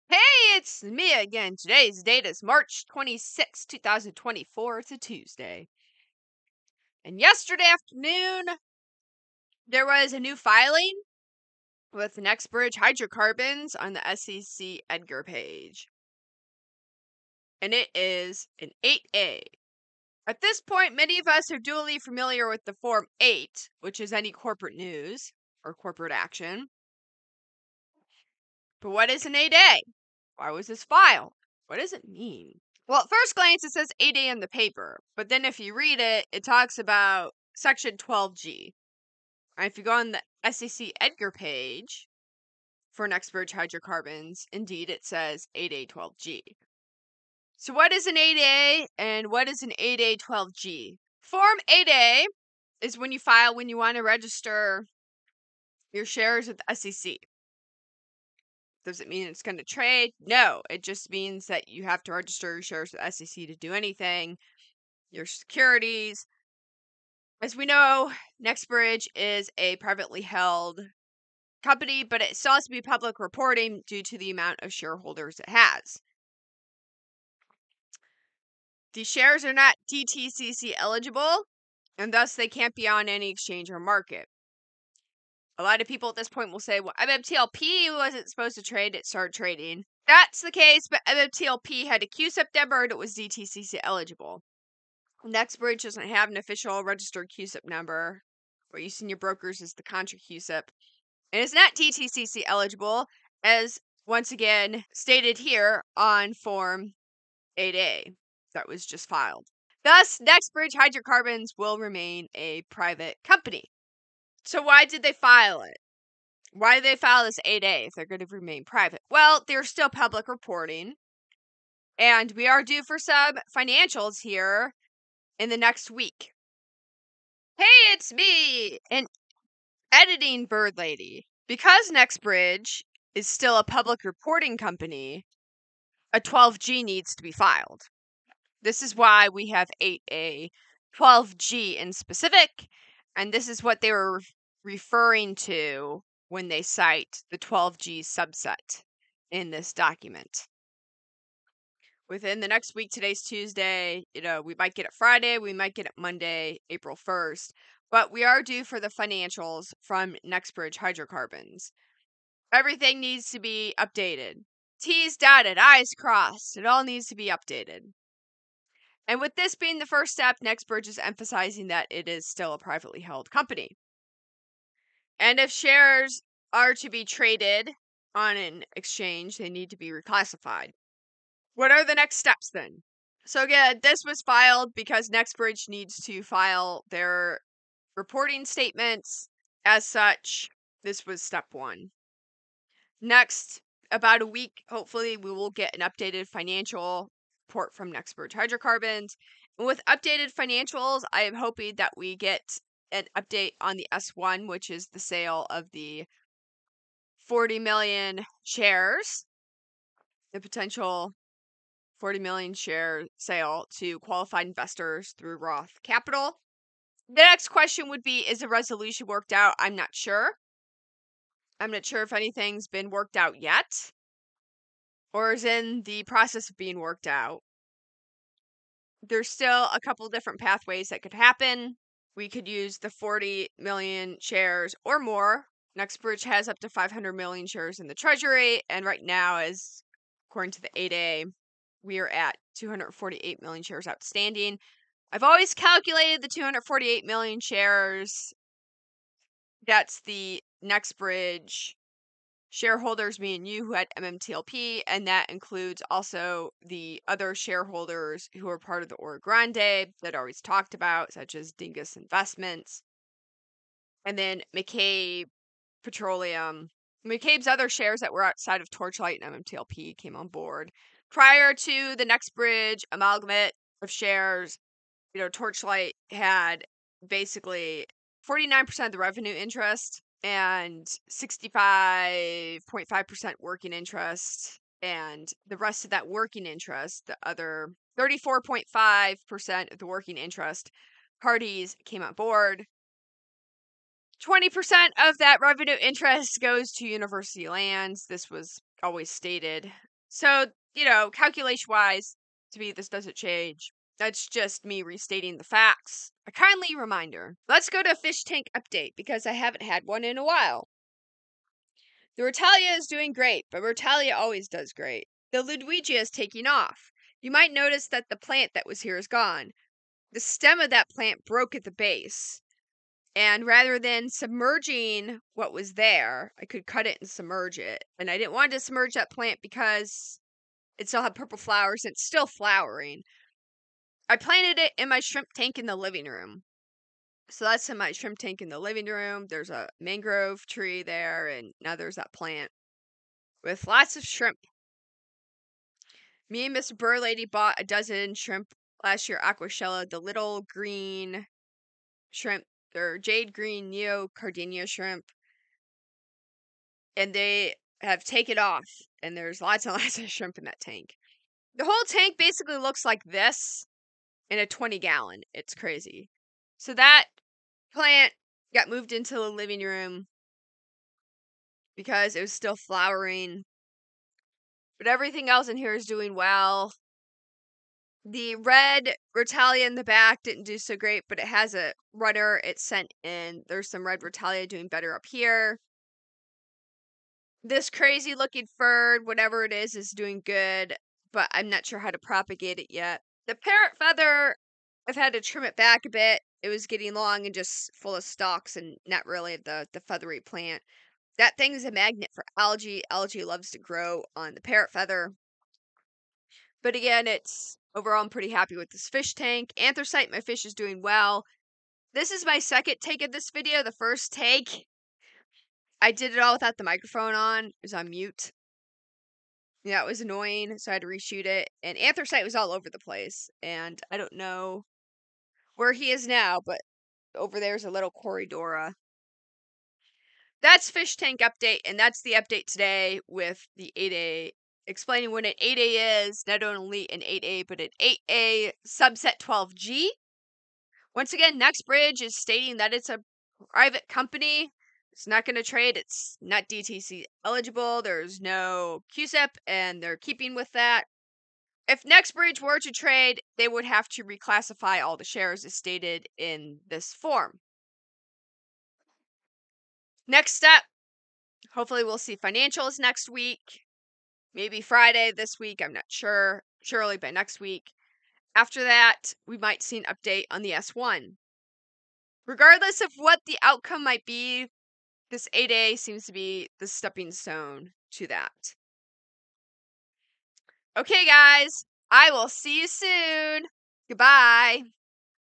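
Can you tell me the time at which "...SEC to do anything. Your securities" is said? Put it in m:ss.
1:03.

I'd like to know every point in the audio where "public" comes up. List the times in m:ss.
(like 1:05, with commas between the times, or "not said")
1:12, 1:59, 2:13.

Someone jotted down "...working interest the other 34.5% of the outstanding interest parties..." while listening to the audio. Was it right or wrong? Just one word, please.
wrong.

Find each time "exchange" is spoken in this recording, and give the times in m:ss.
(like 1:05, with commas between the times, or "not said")
1:23, 2:58.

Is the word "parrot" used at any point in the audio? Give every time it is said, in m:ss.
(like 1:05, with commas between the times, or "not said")
6:33, 6:44.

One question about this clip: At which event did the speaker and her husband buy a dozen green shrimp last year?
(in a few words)
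Aquashella.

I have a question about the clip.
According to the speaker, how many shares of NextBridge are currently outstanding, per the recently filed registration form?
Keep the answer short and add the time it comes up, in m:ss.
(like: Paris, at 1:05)
248 million, at 4:02.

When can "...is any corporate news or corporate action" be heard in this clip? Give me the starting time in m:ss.
0:23.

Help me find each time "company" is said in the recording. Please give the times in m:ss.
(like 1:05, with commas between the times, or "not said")
1:11, 1:53, 2:14, 2:53, 7:23.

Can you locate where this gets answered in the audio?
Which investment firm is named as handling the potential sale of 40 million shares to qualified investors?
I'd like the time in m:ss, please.
3:35.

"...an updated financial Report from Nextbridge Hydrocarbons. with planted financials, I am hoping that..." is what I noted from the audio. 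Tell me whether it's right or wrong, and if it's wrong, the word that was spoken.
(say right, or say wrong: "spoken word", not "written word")
wrong: "updated", not "planted".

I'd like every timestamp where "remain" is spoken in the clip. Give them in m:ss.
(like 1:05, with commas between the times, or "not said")
1:51, 1:58.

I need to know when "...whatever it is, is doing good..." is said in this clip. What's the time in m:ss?
6:29.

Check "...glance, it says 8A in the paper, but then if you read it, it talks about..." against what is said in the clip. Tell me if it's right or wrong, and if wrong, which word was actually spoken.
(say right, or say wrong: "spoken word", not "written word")
right.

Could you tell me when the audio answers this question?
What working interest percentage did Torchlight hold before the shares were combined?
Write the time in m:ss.
4:41.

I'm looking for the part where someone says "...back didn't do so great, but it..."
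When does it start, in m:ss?
6:19.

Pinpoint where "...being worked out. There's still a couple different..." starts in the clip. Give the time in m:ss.
3:46.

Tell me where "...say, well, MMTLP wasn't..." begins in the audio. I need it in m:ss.
1:26.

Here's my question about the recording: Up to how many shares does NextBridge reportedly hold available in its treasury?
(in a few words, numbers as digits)
500 million.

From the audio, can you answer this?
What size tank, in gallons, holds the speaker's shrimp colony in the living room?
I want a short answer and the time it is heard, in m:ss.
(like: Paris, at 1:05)
20 gallons, at 6:04.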